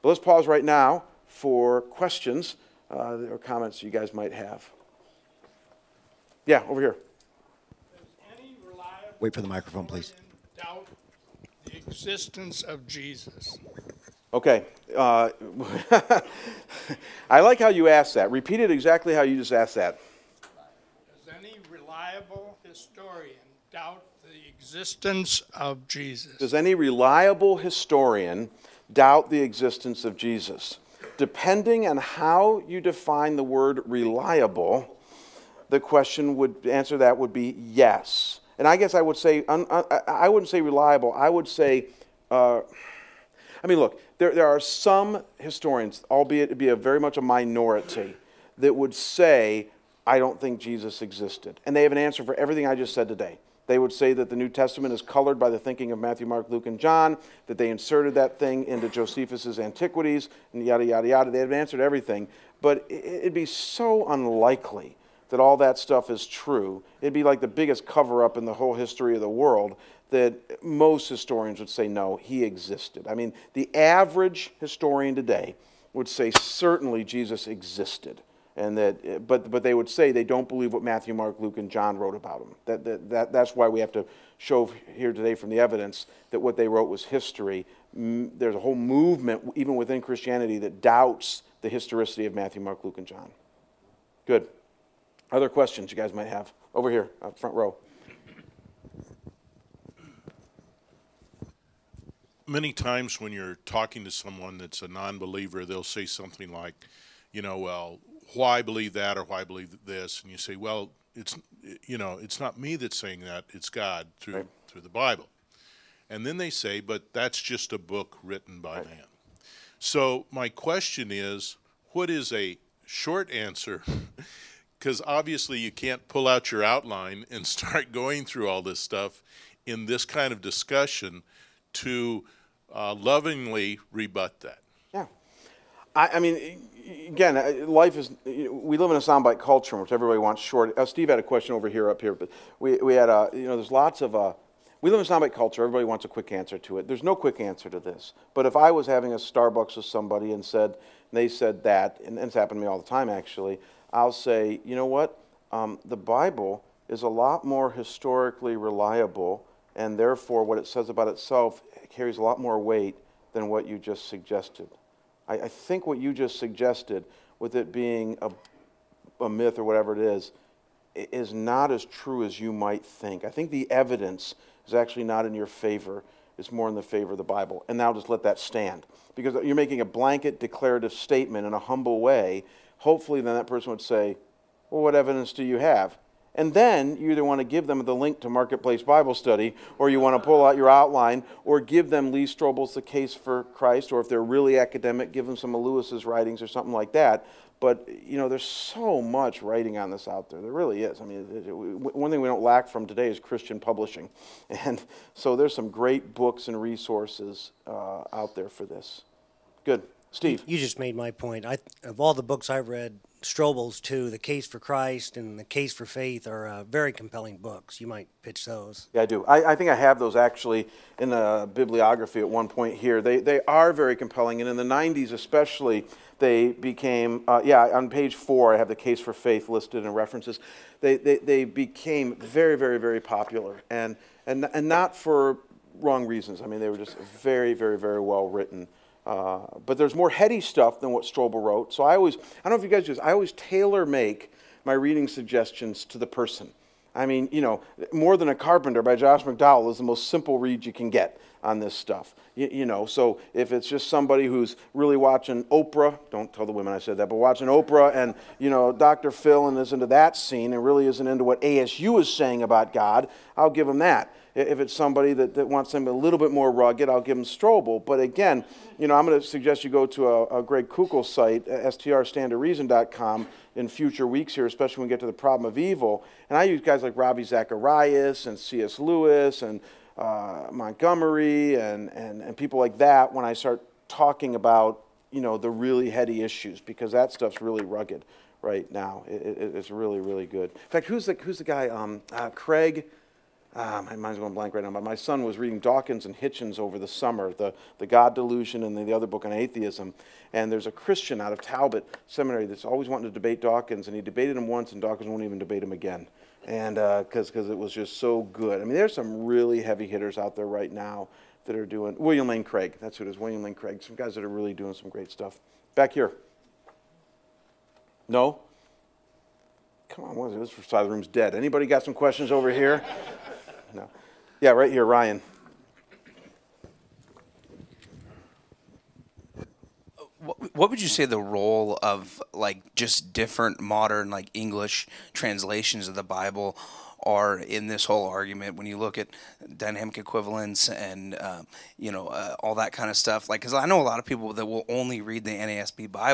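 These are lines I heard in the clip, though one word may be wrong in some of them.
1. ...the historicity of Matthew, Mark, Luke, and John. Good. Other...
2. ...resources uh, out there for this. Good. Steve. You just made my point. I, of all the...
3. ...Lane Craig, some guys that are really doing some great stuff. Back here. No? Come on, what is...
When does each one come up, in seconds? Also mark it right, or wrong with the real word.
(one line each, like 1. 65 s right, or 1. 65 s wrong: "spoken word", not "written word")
1. 91 s right
2. 206 s right
3. 313 s right.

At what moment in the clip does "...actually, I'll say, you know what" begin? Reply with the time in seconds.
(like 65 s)
153 s.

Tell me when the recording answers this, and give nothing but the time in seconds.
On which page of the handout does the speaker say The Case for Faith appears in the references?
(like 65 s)
227 s.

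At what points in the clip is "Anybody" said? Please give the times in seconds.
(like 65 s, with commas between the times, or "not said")
321 s.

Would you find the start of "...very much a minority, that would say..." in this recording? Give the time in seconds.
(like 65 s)
46 s.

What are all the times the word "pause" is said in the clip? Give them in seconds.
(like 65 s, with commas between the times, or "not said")
0 s.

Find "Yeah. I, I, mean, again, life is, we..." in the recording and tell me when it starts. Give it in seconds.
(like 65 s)
134 s.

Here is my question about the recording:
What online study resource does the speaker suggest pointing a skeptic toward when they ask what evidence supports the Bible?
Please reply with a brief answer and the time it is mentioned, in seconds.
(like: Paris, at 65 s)
Marketplace Bible Study, at 188 s.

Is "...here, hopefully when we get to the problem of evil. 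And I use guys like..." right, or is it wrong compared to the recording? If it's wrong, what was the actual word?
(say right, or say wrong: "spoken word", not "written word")
wrong: "especially", not "hopefully".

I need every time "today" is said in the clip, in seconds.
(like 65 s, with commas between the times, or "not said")
53 s, 75 s, 85 s, 202 s.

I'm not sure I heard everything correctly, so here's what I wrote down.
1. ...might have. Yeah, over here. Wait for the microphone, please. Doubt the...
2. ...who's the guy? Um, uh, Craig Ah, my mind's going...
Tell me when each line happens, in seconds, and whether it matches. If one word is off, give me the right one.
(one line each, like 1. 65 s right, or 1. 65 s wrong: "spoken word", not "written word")
1. 4 s right
2. 291 s right.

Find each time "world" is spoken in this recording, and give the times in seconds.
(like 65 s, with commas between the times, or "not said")
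69 s.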